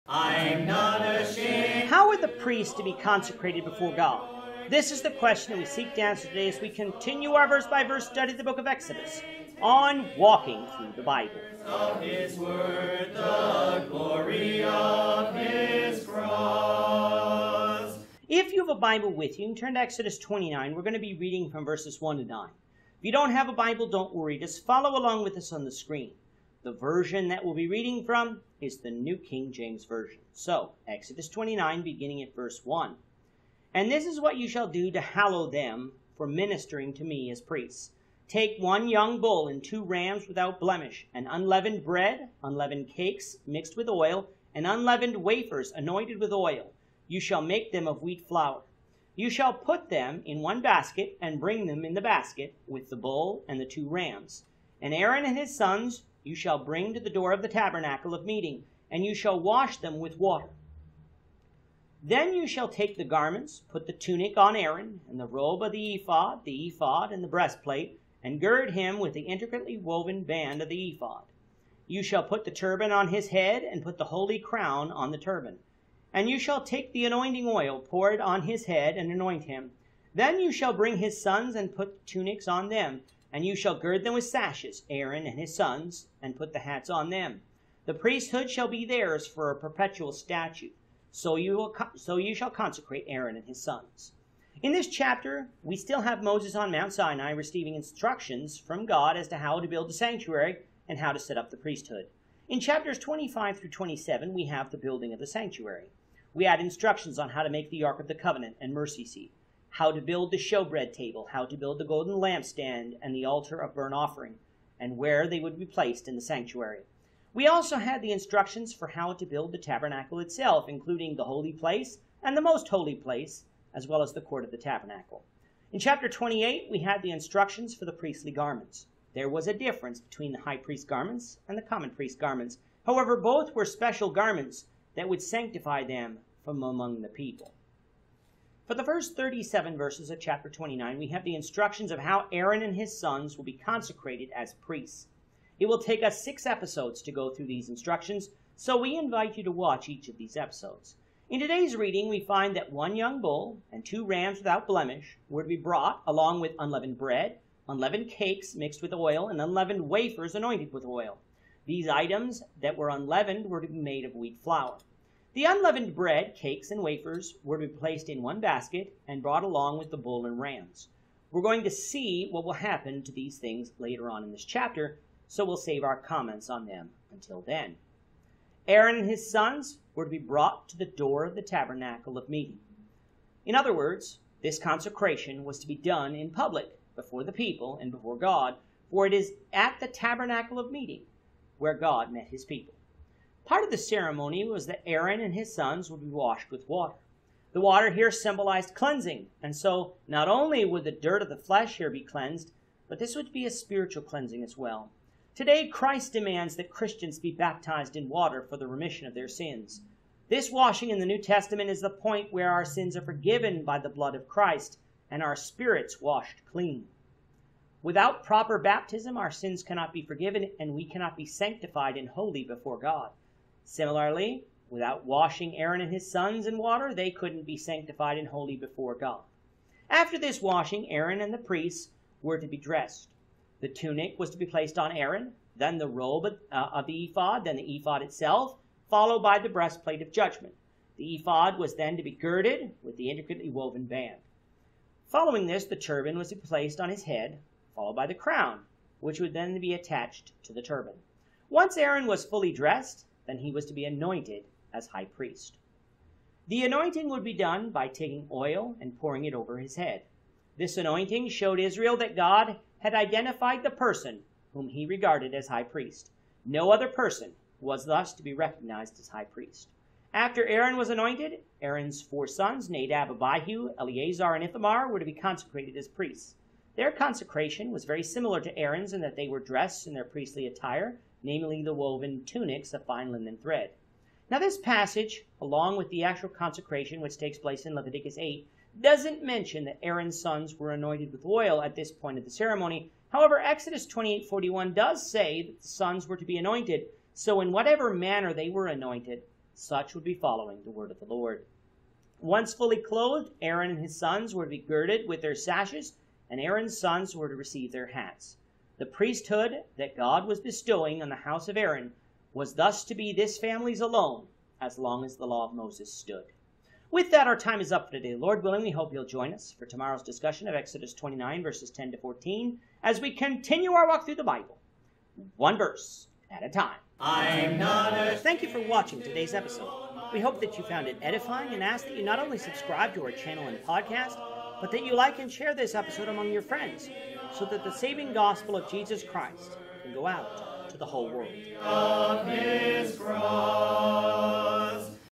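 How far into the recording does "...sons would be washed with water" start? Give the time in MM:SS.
03:15.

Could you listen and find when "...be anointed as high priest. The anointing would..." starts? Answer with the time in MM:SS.
04:13.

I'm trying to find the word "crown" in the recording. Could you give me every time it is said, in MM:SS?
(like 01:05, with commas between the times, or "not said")
01:14, 04:08.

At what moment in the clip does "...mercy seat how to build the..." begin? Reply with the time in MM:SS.
01:48.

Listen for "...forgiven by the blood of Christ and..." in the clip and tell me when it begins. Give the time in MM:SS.
03:33.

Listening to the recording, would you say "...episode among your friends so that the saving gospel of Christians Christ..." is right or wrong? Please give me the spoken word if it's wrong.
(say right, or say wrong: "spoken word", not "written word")
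wrong: "Jesus", not "Christians".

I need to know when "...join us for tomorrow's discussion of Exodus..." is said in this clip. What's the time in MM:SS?
05:19.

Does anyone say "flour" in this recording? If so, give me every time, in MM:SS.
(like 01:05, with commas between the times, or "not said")
00:48, 02:44.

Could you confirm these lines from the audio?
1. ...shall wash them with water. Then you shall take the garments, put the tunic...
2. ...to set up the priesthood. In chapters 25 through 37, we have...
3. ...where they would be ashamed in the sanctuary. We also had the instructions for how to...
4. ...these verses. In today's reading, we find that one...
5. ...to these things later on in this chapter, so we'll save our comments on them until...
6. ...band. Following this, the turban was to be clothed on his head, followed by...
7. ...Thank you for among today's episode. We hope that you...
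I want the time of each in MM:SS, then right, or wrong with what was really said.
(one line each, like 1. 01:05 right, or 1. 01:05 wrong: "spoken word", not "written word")
1. 00:59 right
2. 01:41 wrong: "27", not "37"
3. 01:54 wrong: "placed", not "ashamed"
4. 02:30 wrong: "episodes", not "verses"
5. 02:53 right
6. 04:03 wrong: "placed", not "clothed"
7. 05:28 wrong: "watching", not "among".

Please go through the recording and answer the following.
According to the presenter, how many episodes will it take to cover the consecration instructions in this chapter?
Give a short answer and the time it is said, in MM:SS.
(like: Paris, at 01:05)
6, at 02:26.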